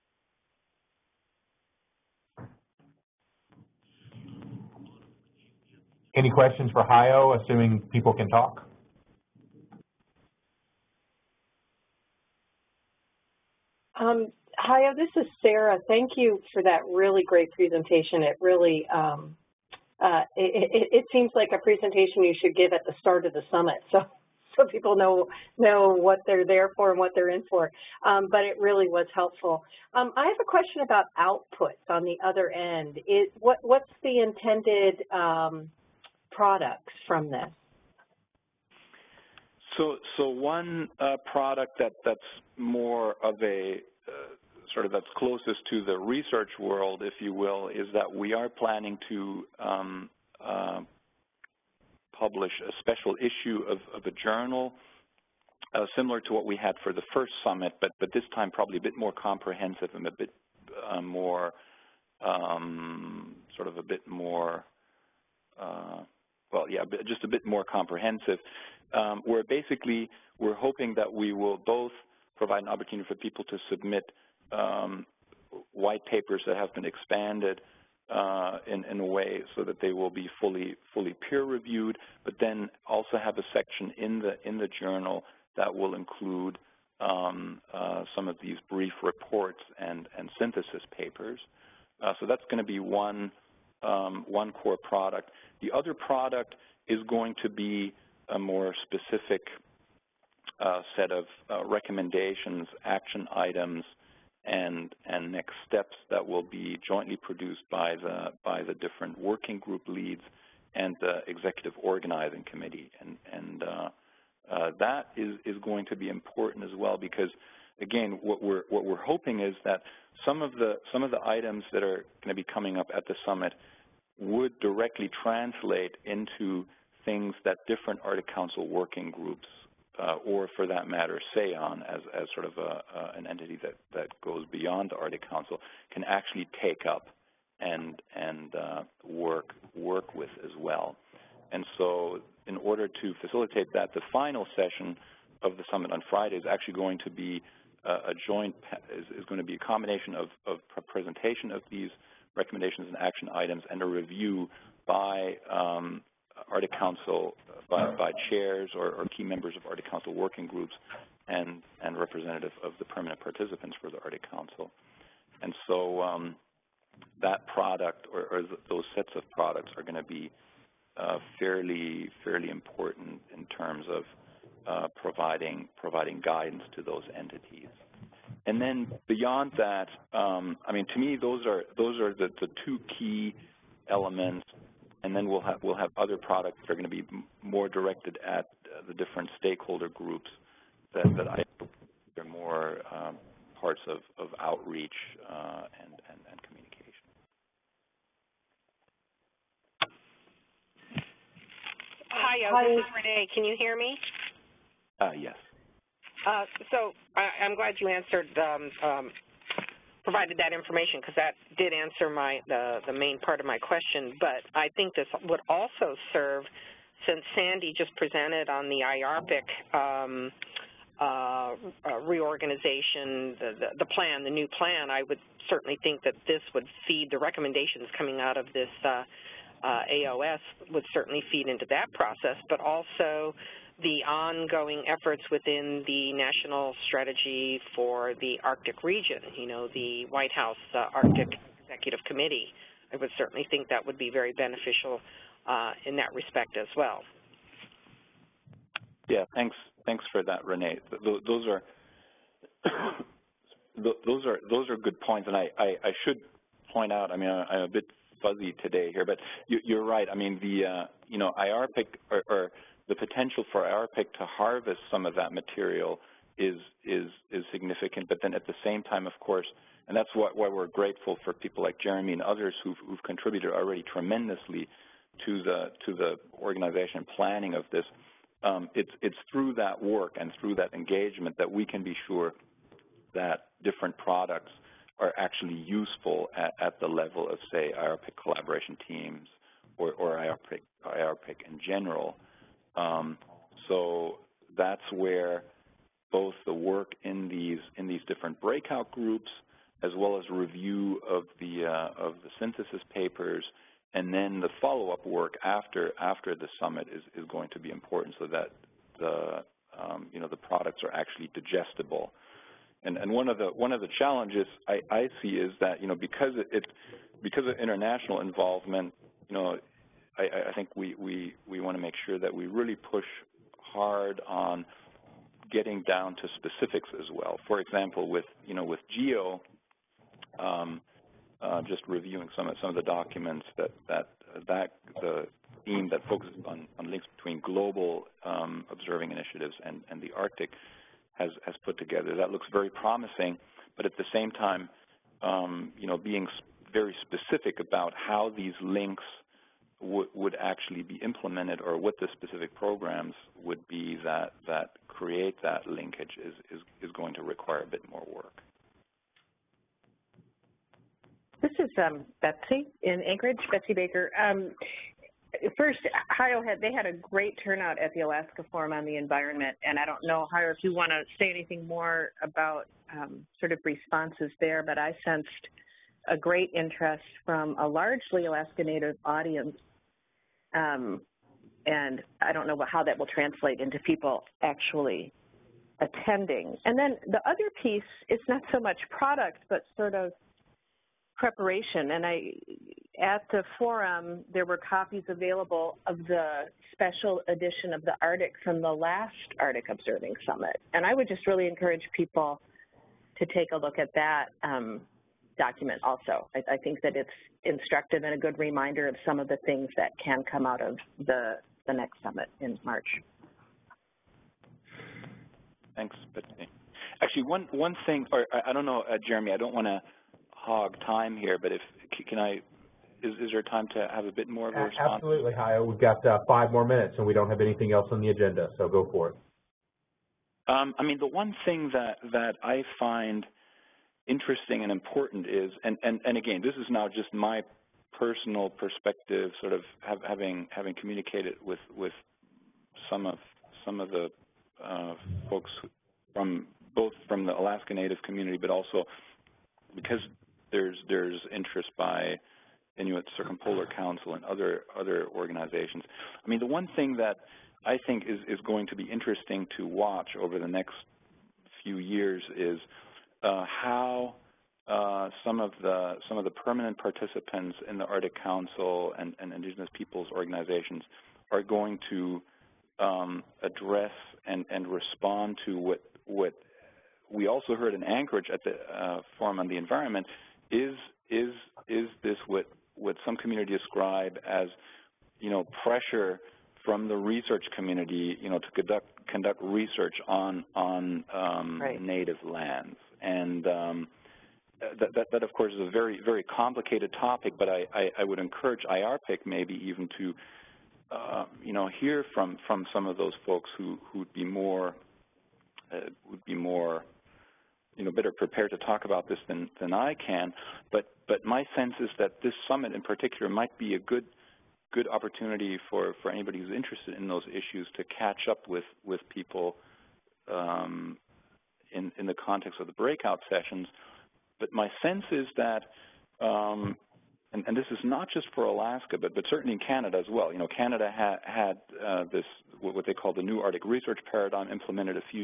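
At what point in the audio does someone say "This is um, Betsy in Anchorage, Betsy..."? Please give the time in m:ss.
6:01.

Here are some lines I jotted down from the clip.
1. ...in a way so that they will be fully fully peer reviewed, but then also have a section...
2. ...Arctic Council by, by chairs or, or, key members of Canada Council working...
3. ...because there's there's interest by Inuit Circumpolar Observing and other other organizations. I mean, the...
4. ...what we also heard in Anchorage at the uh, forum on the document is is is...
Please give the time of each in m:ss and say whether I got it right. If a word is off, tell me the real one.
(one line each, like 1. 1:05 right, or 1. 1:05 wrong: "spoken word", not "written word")
1. 1:18 right
2. 2:36 wrong: "Arctic", not "Canada"
3. 7:29 wrong: "Council", not "Observing"
4. 7:56 wrong: "environment", not "document".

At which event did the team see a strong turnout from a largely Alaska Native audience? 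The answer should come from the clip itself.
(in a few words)
Alaska Forum on the Environment.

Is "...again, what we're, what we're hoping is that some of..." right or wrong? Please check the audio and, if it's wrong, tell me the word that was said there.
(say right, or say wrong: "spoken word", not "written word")
right.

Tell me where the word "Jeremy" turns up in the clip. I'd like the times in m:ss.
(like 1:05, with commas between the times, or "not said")
4:31, 6:59.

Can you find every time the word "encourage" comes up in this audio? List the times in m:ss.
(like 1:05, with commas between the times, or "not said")
6:41, 8:18.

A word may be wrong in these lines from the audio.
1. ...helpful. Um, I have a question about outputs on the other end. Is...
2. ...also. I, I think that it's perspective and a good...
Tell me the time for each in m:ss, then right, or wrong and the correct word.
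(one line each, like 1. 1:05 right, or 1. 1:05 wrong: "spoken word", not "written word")
1. 0:29 right
2. 6:45 wrong: "instructive", not "perspective".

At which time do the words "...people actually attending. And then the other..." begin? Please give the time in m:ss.
6:23.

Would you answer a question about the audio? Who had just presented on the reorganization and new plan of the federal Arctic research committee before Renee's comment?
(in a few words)
Sandy.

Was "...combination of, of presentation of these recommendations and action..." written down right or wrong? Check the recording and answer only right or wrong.
right.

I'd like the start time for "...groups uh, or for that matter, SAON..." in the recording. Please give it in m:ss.
2:09.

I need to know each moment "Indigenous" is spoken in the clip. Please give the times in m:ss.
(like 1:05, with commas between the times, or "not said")
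7:49.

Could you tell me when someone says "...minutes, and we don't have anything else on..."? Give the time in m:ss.
7:06.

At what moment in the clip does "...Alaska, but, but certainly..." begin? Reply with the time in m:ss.
8:48.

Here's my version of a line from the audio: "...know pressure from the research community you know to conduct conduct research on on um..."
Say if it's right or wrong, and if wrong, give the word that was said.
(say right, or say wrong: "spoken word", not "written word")
right.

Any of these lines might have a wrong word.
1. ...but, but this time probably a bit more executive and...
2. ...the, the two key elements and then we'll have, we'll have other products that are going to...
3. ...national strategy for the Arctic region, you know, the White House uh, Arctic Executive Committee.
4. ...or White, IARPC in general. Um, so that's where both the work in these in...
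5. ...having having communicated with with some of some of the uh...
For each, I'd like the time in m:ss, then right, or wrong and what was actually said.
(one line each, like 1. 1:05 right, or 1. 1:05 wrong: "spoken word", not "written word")
1. 0:57 wrong: "comprehensive", not "executive"
2. 3:02 right
3. 3:56 right
4. 4:49 wrong: "IARPC", not "White"
5. 7:20 right.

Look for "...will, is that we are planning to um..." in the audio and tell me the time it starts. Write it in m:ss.
0:47.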